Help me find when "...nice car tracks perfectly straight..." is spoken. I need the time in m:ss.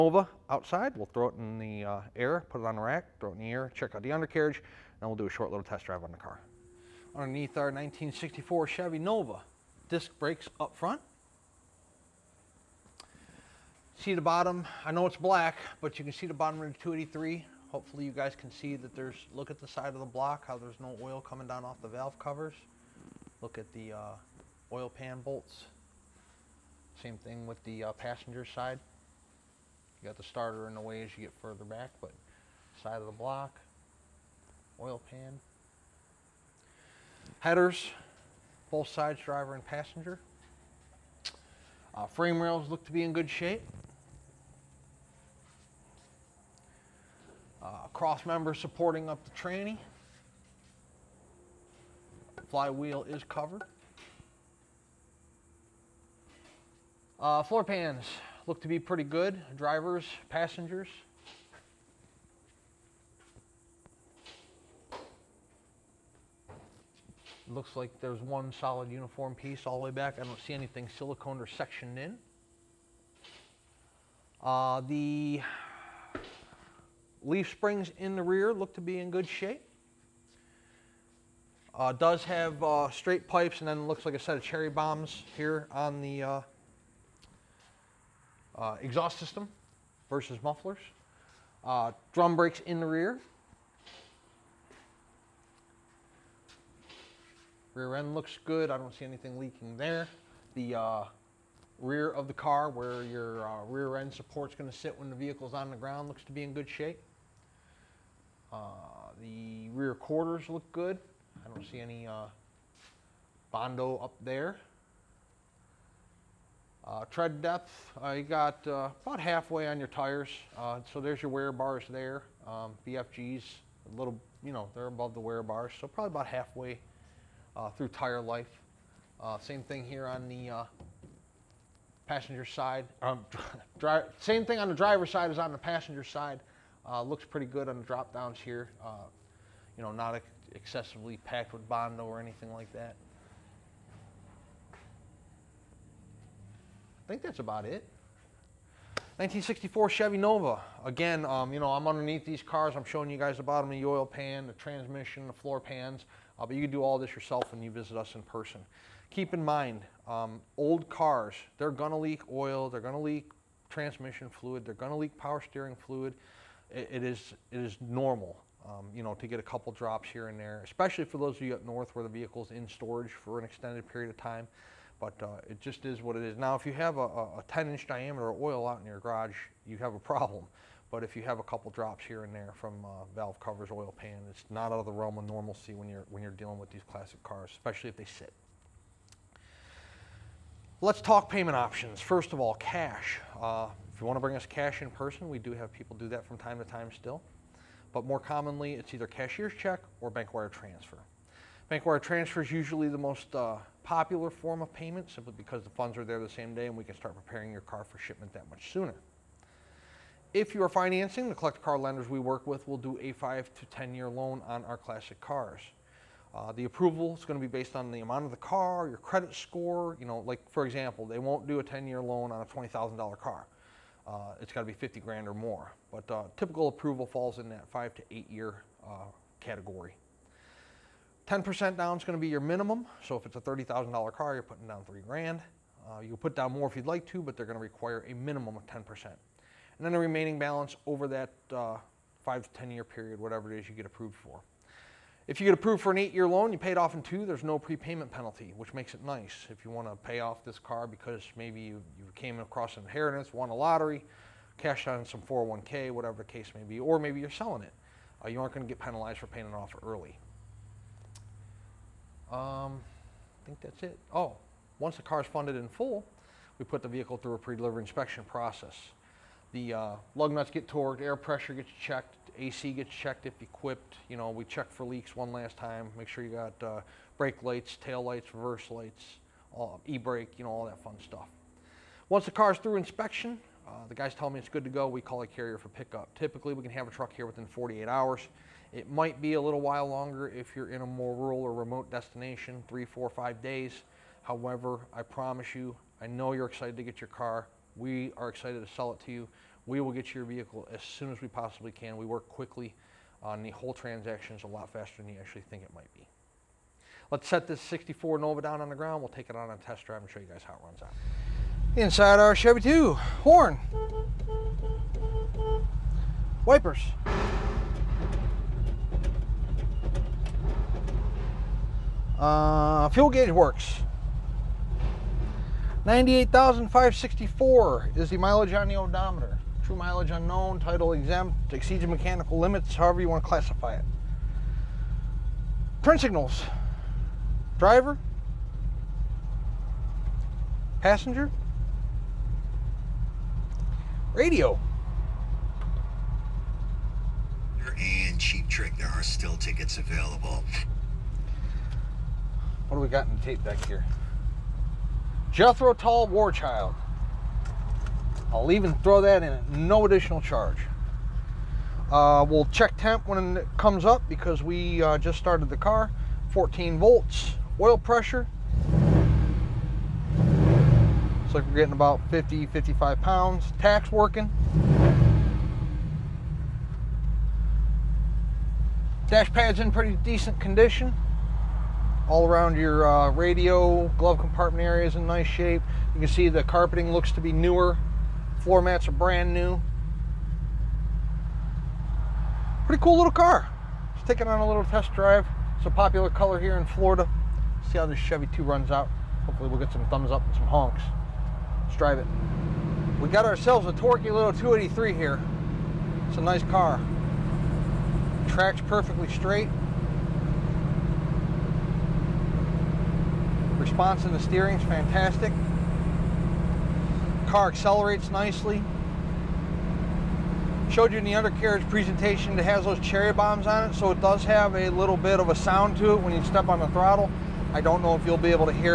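6:46.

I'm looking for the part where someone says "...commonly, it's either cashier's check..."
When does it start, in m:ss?
3:18.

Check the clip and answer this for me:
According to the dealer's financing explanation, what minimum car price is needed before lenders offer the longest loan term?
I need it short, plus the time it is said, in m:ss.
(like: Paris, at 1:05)
50 grand, at 3:44.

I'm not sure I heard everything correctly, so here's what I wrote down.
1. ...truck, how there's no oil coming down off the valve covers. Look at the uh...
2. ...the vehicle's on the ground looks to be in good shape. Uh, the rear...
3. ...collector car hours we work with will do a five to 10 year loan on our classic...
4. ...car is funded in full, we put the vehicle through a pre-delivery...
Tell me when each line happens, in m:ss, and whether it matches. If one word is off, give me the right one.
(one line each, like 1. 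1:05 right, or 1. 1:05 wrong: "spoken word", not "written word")
1. 0:20 wrong: "block", not "truck"
2. 1:45 right
3. 3:31 wrong: "lenders", not "hours"
4. 4:25 right.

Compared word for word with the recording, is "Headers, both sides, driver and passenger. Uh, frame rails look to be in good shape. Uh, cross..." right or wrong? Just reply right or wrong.
right.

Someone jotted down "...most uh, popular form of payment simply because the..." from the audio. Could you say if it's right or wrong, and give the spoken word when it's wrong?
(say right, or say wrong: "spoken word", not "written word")
right.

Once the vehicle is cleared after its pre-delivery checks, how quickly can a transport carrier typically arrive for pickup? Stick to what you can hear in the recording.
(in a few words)
48 hours.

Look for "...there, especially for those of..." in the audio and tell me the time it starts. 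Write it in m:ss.
2:50.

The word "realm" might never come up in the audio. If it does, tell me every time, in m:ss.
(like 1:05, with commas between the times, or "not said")
3:04.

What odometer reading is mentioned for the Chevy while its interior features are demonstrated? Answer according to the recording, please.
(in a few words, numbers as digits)
98,564.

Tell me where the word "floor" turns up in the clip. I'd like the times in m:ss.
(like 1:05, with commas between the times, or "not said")
0:57, 2:35, 6:28.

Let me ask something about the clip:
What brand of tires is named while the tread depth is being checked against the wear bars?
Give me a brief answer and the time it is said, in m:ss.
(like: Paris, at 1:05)
BFGs, at 2:02.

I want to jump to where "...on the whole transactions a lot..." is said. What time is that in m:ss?
5:03.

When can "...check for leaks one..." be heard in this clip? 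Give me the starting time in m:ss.
4:34.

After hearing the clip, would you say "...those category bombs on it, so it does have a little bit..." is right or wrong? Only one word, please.
wrong.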